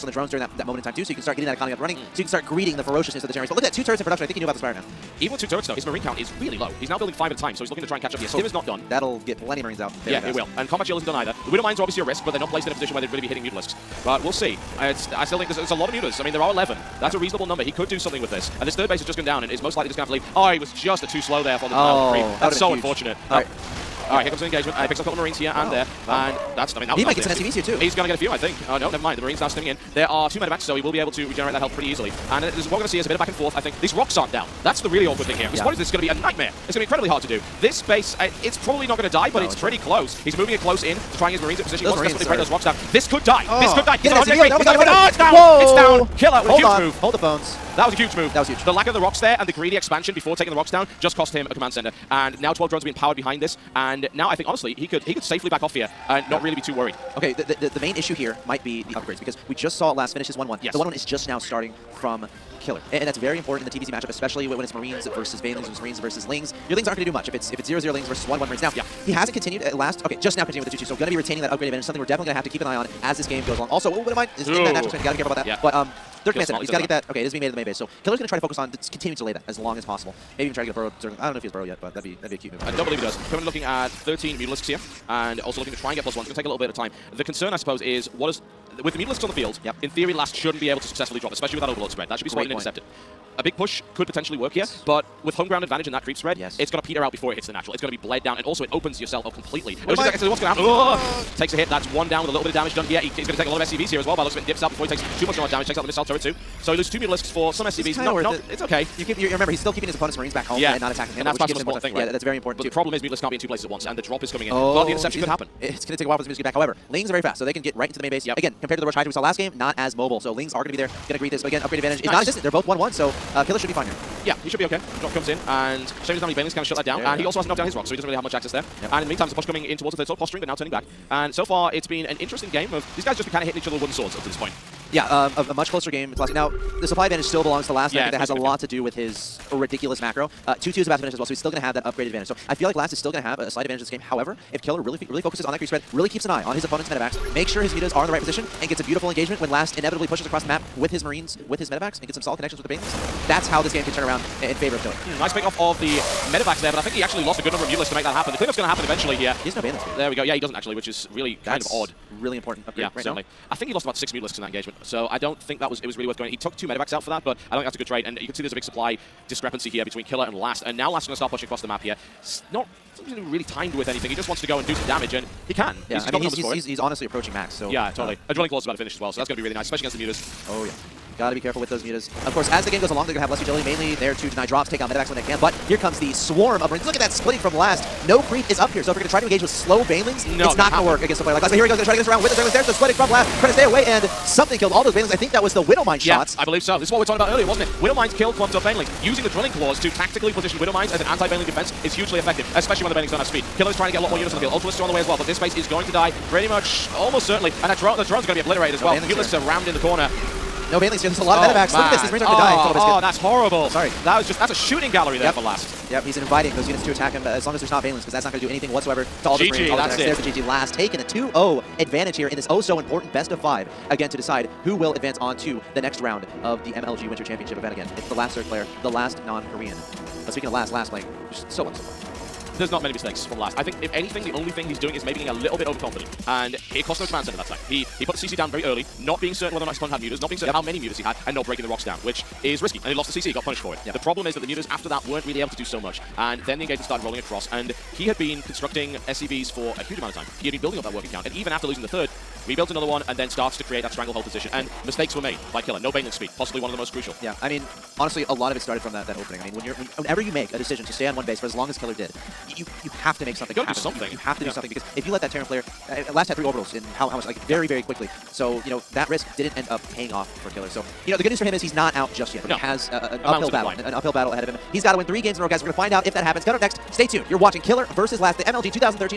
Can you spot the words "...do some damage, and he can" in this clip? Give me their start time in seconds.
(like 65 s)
174 s.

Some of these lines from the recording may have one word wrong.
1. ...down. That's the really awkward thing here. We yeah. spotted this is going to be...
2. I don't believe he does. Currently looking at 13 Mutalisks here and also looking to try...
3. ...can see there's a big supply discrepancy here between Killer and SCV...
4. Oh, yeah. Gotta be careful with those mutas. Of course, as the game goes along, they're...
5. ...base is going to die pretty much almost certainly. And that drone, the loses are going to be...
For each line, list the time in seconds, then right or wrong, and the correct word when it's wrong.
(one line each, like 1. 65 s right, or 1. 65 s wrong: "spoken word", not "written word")
1. 34 s right
2. 82 s right
3. 168 s wrong: "Last", not "SCV"
4. 180 s right
5. 205 s wrong: "drones", not "loses".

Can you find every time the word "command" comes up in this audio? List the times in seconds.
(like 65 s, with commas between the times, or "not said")
51 s, 76 s, 237 s.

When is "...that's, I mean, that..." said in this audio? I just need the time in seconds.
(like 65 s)
26 s.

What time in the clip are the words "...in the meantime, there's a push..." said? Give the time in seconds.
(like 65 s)
129 s.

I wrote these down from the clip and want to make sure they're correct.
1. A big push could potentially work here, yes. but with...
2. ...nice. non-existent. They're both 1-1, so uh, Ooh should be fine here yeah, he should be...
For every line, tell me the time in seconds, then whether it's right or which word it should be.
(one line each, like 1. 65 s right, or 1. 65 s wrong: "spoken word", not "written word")
1. 93 s right
2. 122 s wrong: "Killer", not "Ooh".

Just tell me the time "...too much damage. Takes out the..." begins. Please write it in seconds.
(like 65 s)
105 s.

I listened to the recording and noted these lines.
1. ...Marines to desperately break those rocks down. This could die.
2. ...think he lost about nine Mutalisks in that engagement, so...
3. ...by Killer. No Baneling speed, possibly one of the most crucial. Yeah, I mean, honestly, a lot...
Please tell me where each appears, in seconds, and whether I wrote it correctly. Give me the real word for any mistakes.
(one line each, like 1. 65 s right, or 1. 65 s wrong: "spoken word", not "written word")
1. 41 s right
2. 163 s wrong: "six", not "nine"
3. 255 s right.